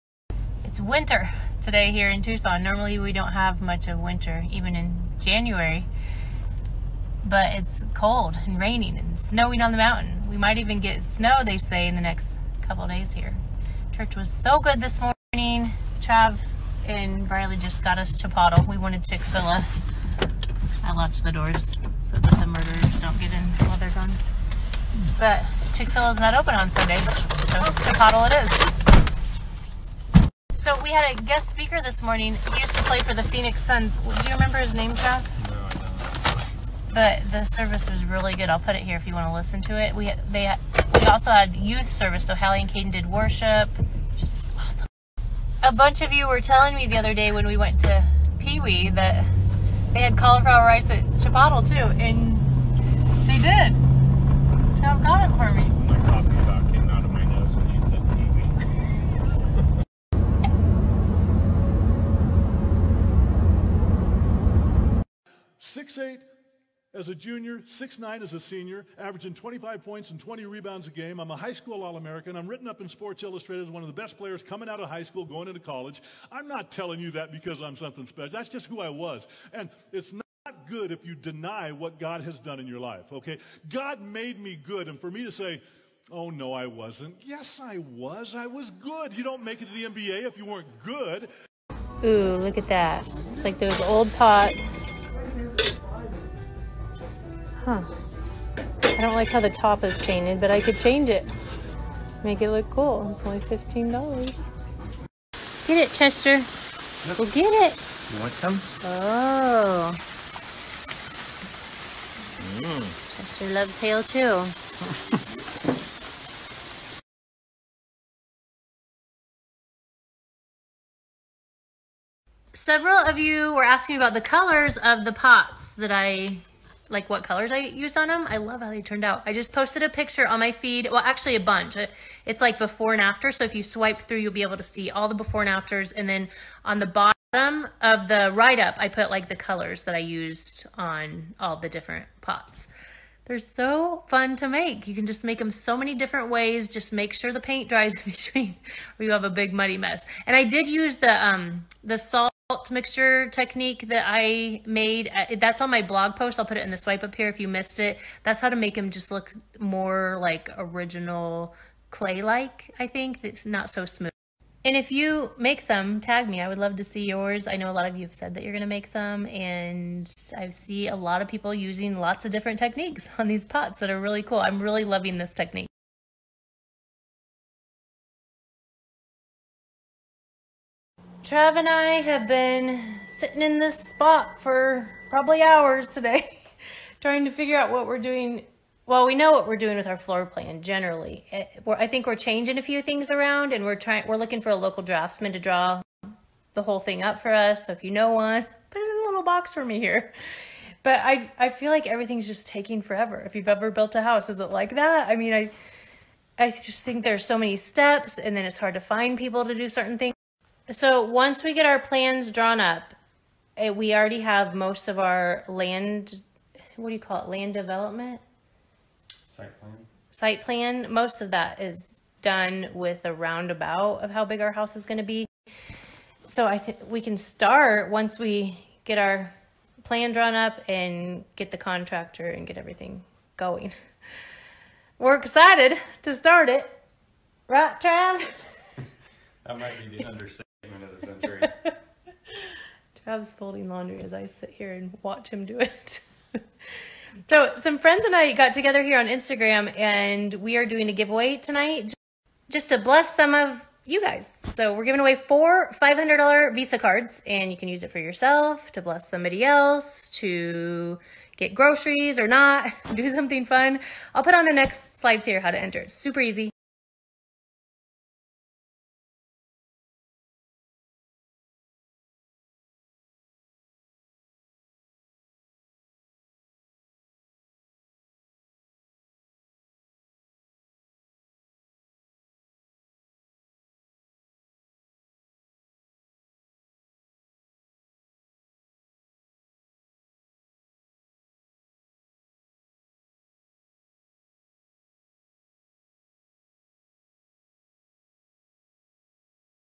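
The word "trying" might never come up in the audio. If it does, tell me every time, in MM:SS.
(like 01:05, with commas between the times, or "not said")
03:06, 03:13.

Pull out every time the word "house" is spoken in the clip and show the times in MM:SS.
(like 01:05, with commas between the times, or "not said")
03:24, 03:44.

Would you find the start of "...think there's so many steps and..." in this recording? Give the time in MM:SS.
03:26.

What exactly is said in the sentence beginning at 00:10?
We might even get snow, they say, in the next couple days here.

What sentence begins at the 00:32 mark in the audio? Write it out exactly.
He used to play for the Phoenix Suns.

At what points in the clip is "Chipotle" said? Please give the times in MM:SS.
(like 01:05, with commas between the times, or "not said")
00:18, 00:27, 00:51.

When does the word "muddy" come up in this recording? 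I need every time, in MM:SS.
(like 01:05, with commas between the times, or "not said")
02:29.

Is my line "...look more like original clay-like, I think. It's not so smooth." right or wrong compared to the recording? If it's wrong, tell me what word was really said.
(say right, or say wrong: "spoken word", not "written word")
right.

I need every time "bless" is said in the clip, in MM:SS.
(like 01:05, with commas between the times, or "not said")
04:12, 04:18.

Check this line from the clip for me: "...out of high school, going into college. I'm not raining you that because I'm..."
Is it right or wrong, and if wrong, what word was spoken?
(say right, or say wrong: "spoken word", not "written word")
wrong: "telling", not "raining".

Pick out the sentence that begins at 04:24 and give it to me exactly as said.
I'll put on the next slides here how to enter.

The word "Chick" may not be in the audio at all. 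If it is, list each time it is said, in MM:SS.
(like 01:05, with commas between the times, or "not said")
00:19, 00:25.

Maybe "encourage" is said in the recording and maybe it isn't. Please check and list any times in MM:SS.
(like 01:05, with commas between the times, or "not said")
not said.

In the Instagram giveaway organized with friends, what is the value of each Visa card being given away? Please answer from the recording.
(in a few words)
$500.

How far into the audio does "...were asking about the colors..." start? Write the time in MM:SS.
02:03.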